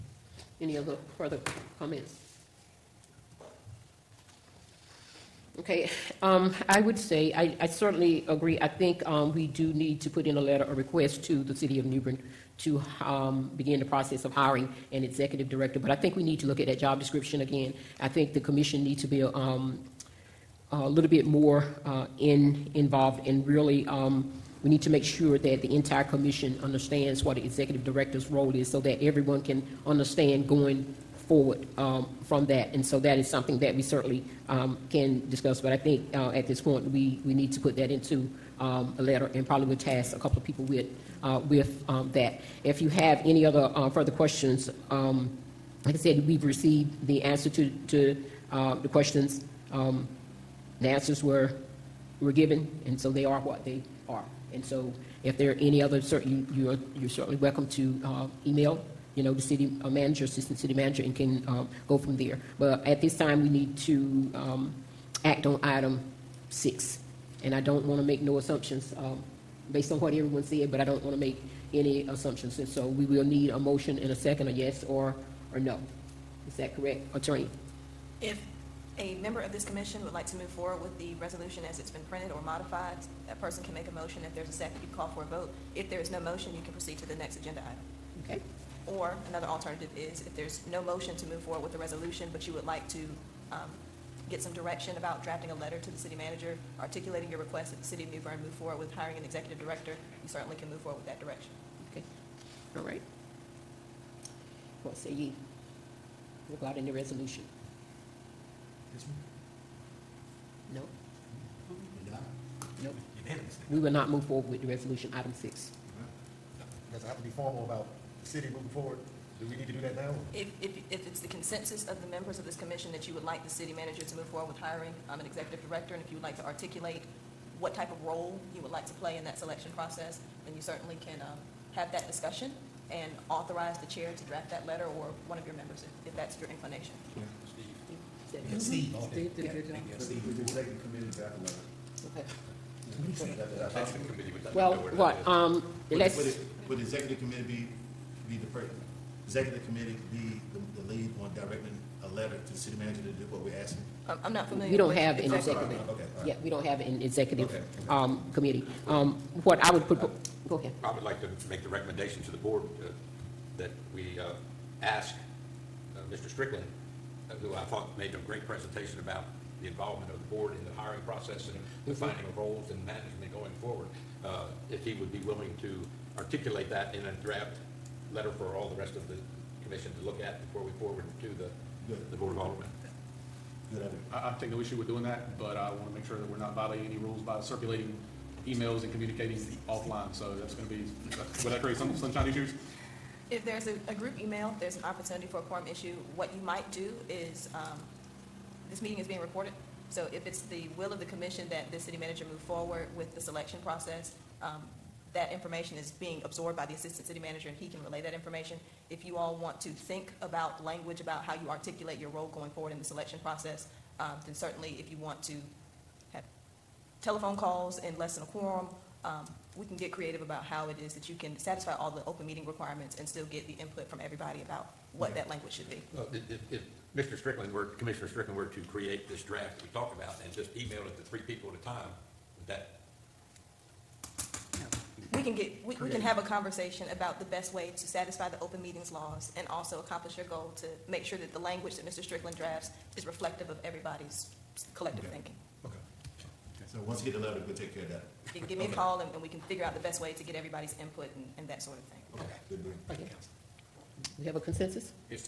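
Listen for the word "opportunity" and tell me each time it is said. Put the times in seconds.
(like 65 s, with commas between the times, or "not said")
194 s.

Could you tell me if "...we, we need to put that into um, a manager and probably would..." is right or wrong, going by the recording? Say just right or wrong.
wrong.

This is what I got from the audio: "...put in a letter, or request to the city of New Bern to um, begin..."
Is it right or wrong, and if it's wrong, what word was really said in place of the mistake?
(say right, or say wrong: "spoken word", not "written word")
right.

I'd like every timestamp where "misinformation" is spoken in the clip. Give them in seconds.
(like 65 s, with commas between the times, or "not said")
not said.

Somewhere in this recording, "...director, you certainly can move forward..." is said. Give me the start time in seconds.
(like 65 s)
99 s.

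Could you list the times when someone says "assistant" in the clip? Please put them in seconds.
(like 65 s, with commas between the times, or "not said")
60 s, 206 s.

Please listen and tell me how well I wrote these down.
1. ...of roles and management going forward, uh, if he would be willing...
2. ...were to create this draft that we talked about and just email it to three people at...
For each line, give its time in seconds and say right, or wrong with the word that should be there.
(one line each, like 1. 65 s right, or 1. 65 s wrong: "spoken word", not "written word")
1. 172 s right
2. 228 s right.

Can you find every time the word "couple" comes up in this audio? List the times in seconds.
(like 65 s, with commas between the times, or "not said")
40 s.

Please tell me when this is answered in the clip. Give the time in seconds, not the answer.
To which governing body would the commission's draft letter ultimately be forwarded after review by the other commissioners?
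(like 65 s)
182 s.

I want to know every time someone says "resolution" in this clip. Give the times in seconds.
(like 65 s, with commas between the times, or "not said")
81 s, 91 s, 106 s, 114 s.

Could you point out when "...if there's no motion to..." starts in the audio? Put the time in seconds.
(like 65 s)
90 s.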